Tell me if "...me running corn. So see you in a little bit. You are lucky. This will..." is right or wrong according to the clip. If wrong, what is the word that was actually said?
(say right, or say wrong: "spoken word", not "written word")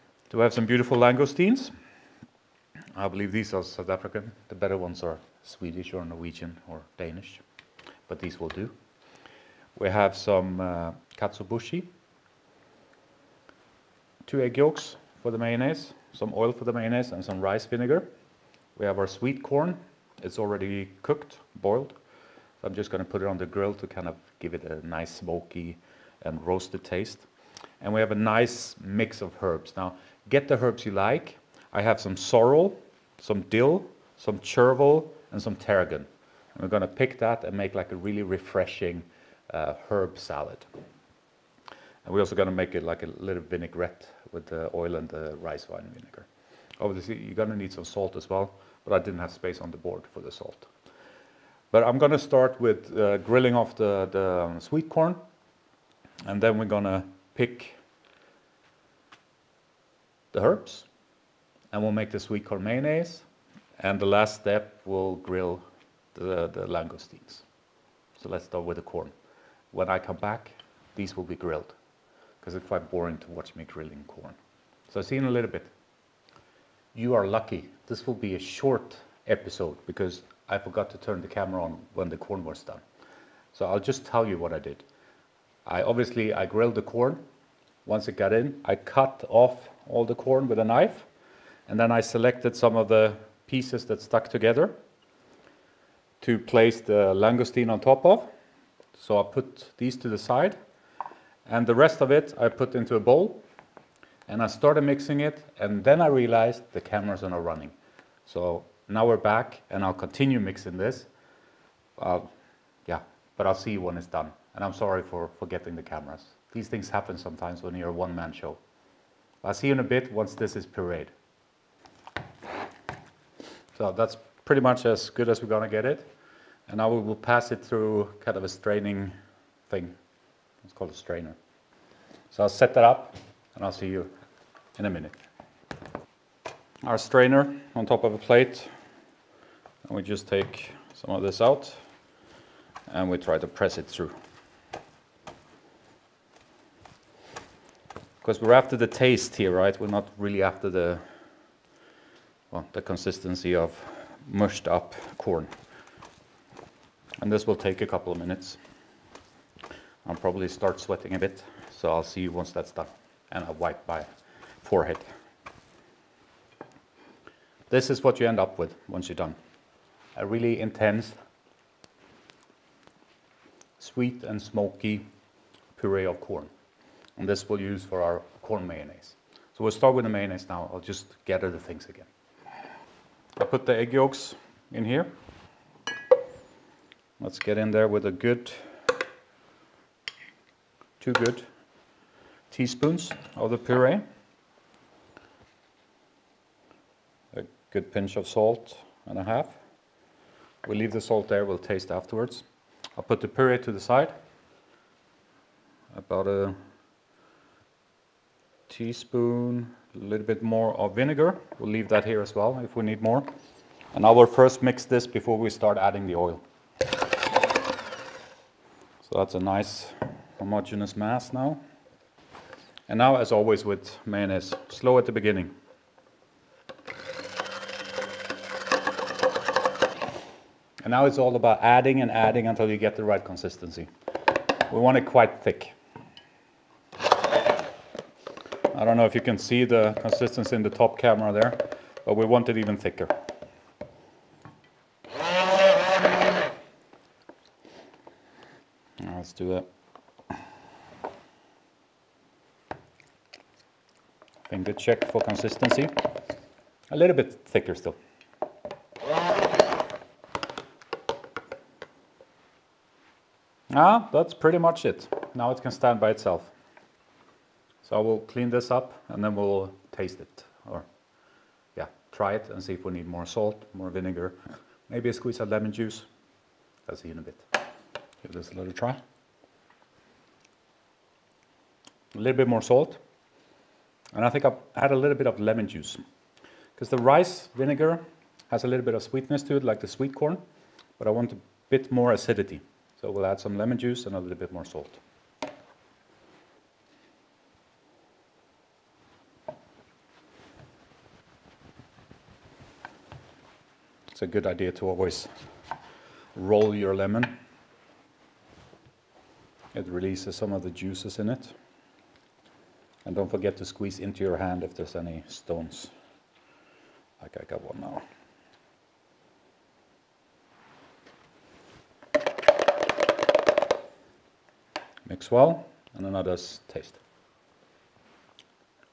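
wrong: "grilling", not "running".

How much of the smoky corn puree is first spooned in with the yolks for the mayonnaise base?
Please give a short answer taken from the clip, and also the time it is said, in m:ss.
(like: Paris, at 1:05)
2 teaspoons, at 3:11.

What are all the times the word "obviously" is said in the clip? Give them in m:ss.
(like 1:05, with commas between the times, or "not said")
0:46, 1:25.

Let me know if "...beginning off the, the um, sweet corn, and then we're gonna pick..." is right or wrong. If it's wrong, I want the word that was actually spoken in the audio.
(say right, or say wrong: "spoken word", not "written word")
wrong: "grilling", not "beginning".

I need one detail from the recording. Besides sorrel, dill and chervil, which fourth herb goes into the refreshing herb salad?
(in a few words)
Tarragon.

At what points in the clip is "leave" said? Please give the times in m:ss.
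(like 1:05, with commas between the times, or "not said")
3:20, 3:31.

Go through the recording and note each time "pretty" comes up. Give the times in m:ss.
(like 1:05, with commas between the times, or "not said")
2:04, 4:24.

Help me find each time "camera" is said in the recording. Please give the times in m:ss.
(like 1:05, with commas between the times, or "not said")
1:21, 1:46, 1:55, 4:00.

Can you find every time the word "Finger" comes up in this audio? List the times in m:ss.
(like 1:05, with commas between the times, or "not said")
4:14.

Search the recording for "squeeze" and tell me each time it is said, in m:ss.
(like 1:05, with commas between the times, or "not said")
4:35, 5:13.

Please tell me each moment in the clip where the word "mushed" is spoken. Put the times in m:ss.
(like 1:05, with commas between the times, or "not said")
2:34.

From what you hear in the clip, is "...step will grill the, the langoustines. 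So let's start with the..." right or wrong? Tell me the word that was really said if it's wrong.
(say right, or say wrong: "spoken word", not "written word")
right.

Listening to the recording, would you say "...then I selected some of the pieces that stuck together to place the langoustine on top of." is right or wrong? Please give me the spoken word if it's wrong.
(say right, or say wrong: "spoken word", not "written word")
right.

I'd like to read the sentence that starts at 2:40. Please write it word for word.
I'll probably start sweating a bit, so I'll see you once that's done.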